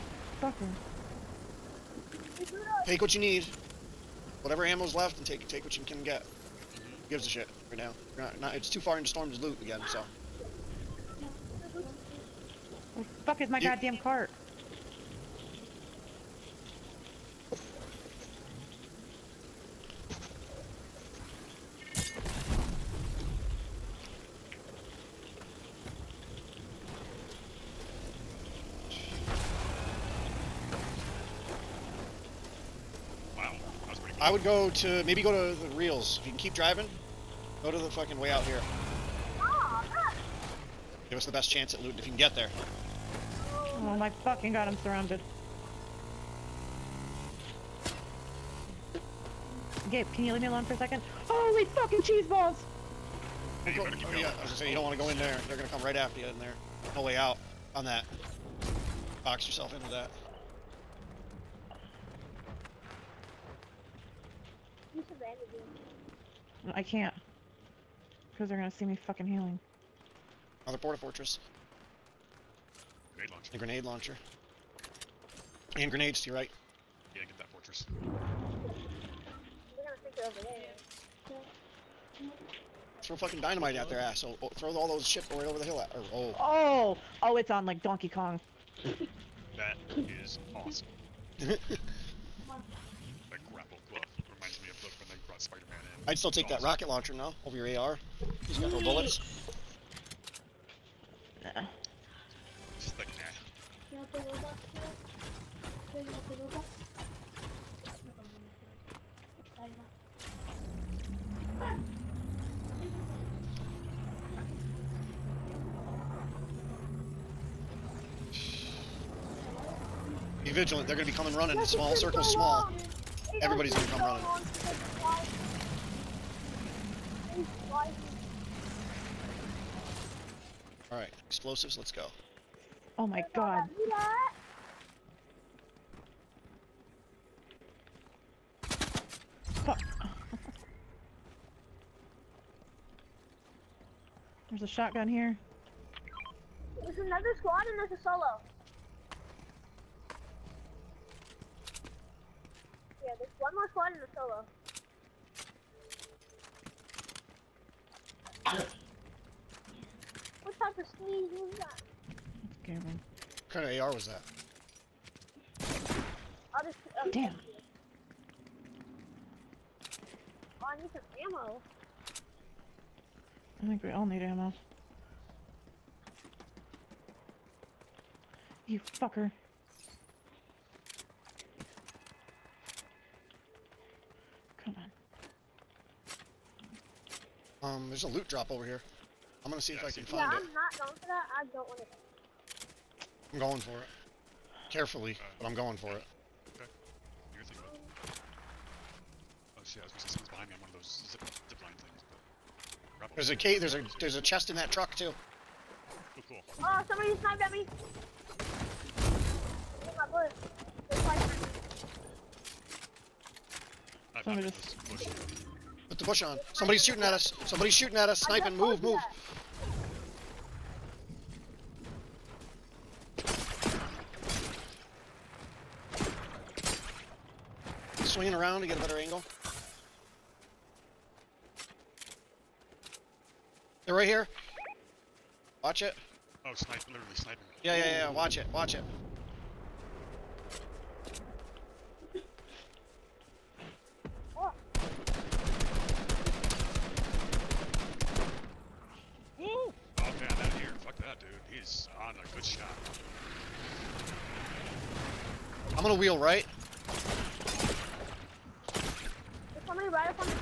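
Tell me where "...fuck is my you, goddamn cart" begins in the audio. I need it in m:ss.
0:13.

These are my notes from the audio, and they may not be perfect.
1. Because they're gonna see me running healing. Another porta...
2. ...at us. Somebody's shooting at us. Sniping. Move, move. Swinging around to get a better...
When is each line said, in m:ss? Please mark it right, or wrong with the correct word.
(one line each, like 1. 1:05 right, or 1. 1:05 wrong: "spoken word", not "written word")
1. 1:08 wrong: "fucking", not "running"
2. 3:37 right.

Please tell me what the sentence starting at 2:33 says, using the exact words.
Yeah, there's one more squad and a solo.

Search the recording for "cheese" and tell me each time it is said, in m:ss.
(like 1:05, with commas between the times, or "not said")
0:52.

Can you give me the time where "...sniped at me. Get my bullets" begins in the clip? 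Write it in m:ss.
3:27.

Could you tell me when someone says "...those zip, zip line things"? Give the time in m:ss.
3:20.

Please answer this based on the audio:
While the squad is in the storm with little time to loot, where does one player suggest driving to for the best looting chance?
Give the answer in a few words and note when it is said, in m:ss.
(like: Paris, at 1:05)
The reels, at 0:35.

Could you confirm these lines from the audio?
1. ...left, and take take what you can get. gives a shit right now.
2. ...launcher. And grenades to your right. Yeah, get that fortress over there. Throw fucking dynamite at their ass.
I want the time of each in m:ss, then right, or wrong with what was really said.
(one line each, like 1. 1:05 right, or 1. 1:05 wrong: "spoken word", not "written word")
1. 0:04 right
2. 1:13 right.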